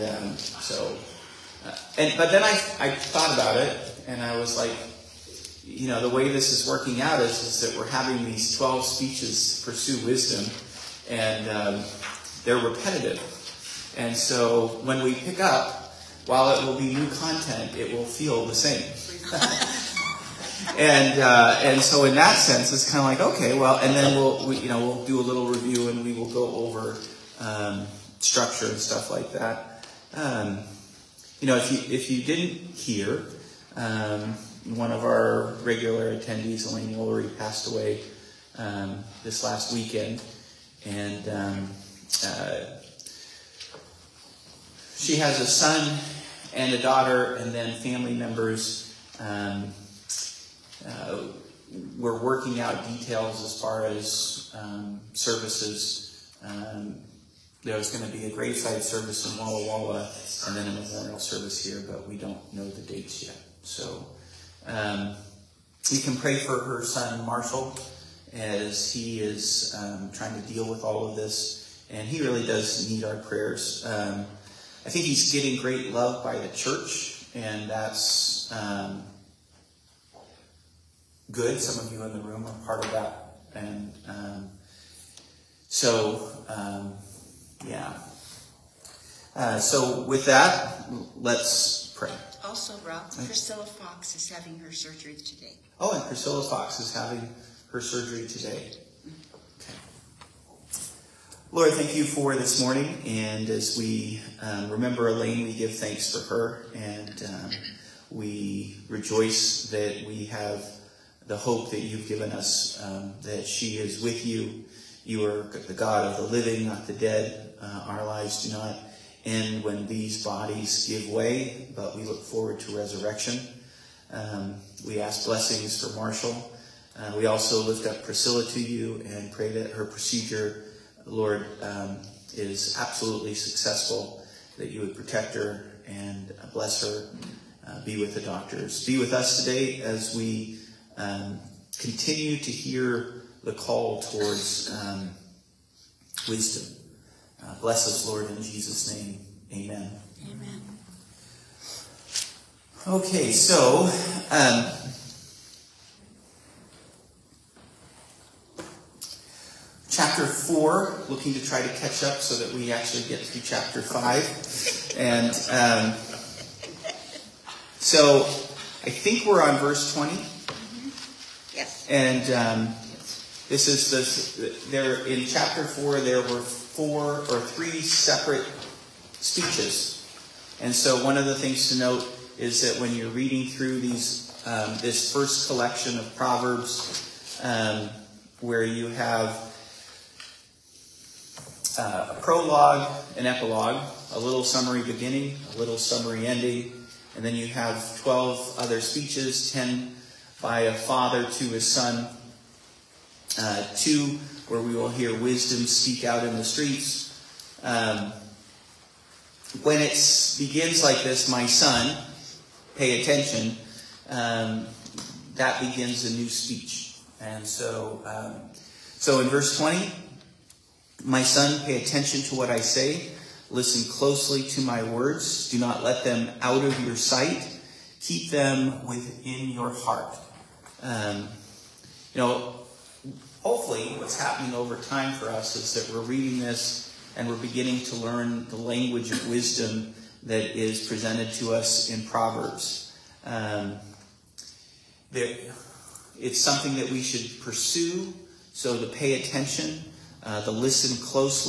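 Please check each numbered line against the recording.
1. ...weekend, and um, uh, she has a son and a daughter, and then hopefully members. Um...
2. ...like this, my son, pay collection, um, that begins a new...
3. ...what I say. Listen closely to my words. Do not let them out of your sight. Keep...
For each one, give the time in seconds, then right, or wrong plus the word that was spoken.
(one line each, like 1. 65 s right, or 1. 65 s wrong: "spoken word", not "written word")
1. 39 s wrong: "family", not "hopefully"
2. 210 s wrong: "attention", not "collection"
3. 222 s right.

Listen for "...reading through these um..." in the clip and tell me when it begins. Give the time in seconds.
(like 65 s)
183 s.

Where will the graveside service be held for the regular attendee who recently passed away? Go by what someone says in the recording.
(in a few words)
Walla Walla.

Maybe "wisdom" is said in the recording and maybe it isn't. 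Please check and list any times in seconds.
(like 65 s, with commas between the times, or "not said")
10 s, 146 s, 205 s, 239 s.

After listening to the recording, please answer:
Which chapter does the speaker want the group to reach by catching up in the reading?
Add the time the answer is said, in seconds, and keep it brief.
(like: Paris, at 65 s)
Chapter 5, at 163 s.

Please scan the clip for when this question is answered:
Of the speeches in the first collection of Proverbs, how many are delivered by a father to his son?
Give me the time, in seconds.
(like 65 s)
199 s.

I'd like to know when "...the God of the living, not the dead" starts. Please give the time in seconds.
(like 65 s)
115 s.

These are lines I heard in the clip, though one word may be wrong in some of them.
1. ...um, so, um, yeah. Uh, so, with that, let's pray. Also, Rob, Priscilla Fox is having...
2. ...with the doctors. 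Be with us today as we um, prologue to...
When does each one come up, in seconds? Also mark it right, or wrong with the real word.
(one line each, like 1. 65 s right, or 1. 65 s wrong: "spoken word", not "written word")
1. 84 s right
2. 137 s wrong: "continue", not "prologue".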